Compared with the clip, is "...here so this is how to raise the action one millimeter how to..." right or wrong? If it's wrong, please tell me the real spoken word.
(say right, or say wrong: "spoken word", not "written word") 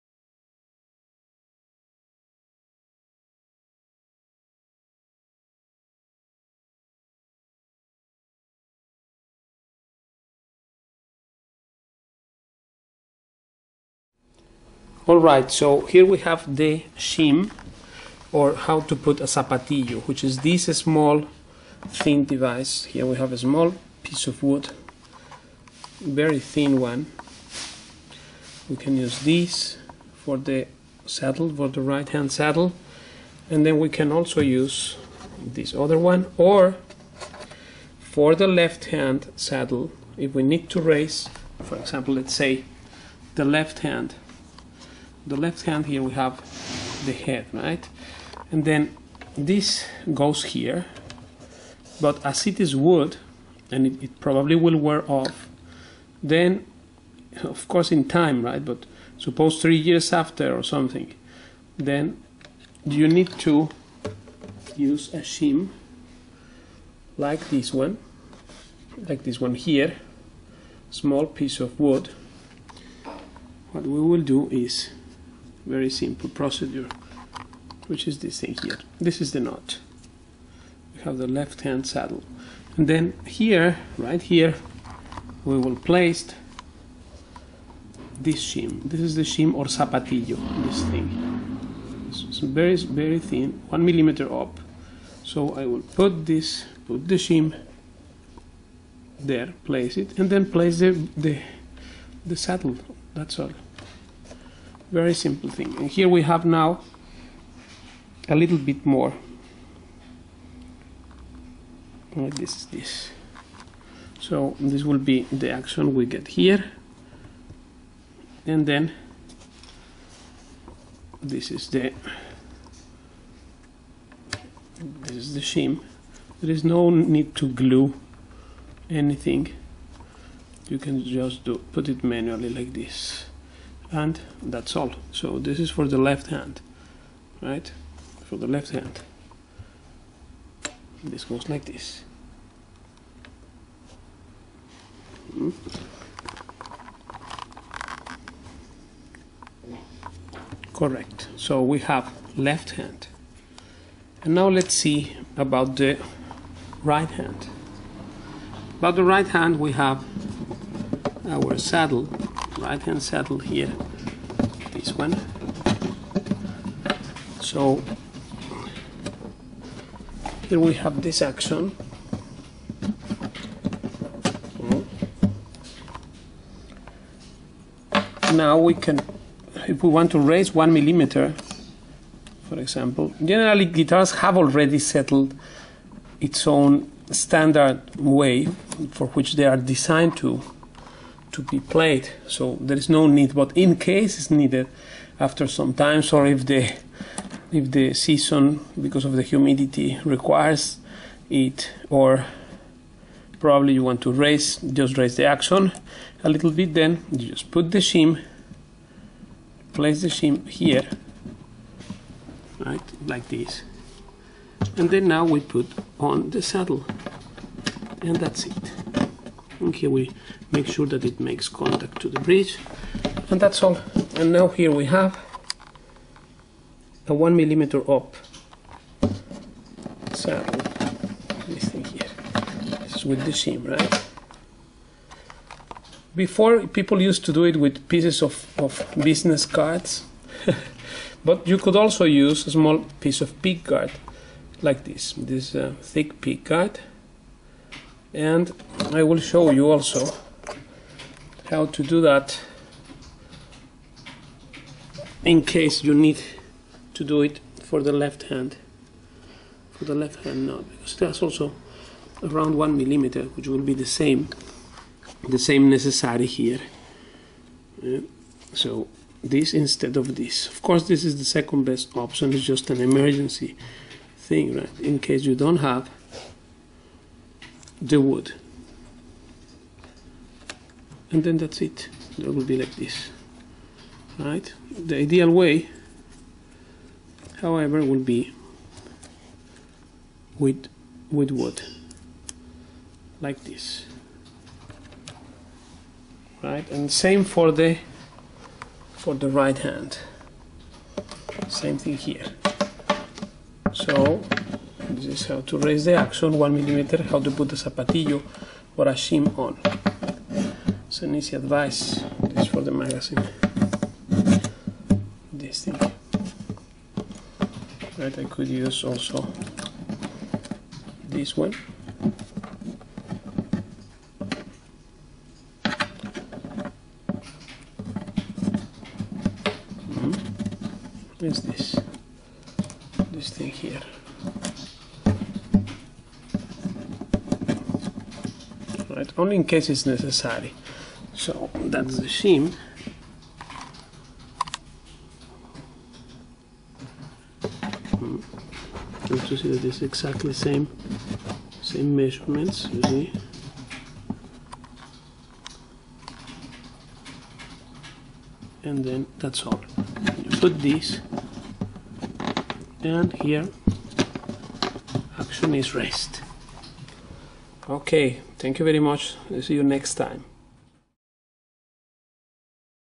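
right.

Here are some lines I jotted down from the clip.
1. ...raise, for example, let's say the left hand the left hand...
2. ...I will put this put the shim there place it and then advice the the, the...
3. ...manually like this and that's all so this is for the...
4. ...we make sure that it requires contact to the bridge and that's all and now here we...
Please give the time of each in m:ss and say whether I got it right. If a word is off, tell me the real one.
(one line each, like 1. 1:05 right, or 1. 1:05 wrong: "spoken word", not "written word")
1. 0:40 right
2. 1:35 wrong: "place", not "advice"
3. 2:12 right
4. 3:39 wrong: "makes", not "requires".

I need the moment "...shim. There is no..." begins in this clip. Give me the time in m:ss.
2:05.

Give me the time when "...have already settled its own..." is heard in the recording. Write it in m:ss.
3:04.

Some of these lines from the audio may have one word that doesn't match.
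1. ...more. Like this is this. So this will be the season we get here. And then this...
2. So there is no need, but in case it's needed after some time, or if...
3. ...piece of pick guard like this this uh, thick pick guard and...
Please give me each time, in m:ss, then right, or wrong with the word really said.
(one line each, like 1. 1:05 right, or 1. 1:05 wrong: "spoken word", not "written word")
1. 1:48 wrong: "action", not "season"
2. 3:12 right
3. 4:02 right.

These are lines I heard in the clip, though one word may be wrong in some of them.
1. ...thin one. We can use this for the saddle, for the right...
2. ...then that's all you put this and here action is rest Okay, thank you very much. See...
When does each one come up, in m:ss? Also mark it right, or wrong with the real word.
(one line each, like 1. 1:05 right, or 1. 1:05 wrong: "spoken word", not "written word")
1. 0:26 right
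2. 5:58 right.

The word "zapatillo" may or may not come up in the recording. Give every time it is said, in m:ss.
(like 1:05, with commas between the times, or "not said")
0:19, 1:29, 5:07.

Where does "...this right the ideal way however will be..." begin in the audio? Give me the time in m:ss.
4:42.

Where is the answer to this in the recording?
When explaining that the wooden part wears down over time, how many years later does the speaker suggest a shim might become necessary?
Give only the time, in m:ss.
0:59.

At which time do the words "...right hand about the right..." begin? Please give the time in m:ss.
2:36.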